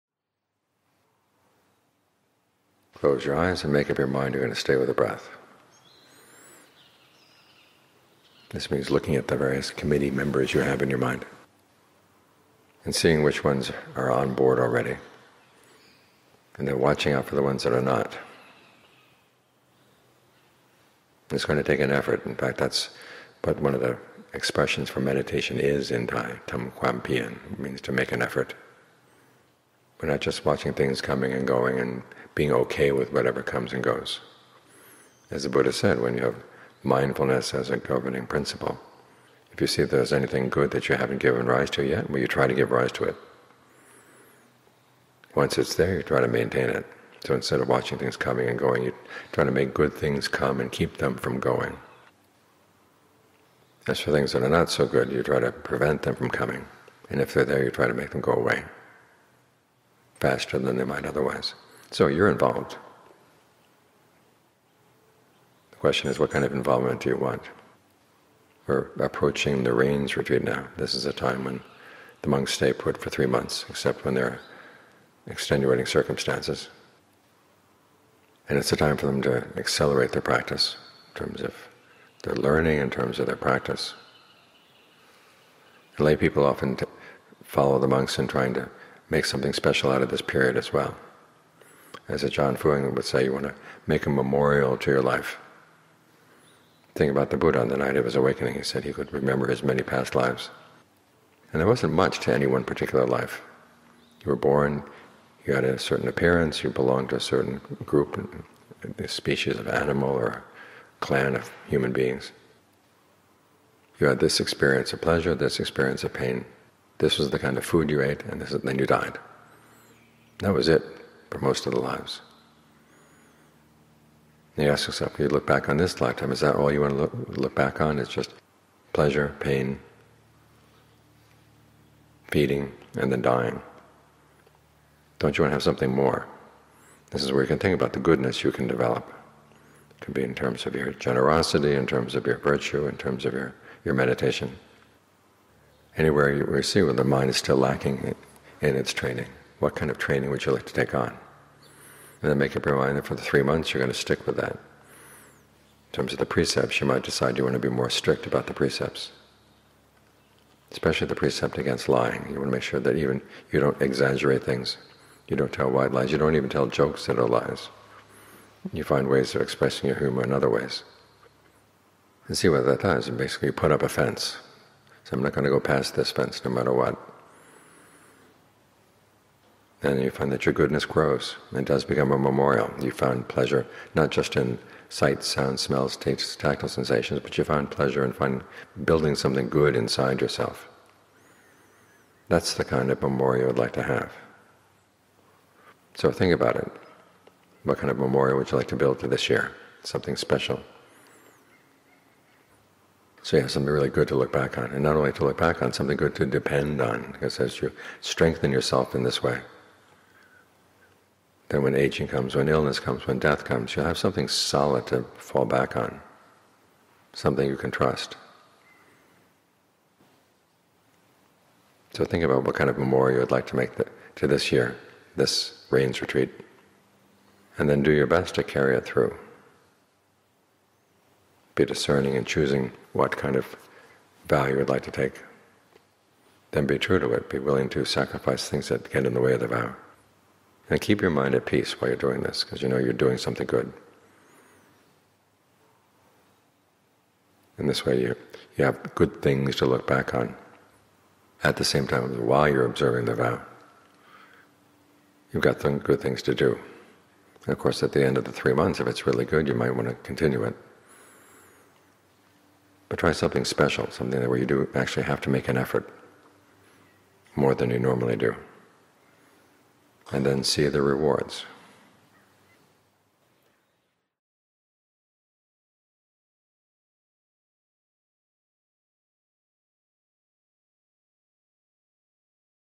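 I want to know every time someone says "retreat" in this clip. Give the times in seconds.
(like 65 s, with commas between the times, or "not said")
70 s, 226 s.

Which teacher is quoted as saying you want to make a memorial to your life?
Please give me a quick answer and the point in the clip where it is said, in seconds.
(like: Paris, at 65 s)
Ajaan Fuang, at 92 s.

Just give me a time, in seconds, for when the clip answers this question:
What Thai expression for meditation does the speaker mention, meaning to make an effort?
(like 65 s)
26 s.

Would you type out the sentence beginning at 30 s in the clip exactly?
We're not just watching things coming and going and being okay with whatever comes and goes.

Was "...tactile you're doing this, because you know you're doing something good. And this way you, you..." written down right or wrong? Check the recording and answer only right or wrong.
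wrong.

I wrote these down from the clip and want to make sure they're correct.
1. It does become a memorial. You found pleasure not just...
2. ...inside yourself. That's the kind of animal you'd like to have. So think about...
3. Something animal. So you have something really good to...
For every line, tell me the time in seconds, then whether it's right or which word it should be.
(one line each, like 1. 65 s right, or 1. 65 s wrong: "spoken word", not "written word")
1. 181 s right
2. 189 s wrong: "memorial", not "animal"
3. 199 s wrong: "special", not "animal".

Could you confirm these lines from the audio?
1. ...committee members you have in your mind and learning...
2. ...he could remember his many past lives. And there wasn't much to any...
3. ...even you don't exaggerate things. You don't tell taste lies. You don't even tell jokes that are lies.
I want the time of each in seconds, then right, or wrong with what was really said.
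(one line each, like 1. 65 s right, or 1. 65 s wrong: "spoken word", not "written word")
1. 9 s wrong: "seeing", not "learning"
2. 98 s right
3. 162 s wrong: "white", not "taste".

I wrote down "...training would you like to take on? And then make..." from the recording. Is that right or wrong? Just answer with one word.
right.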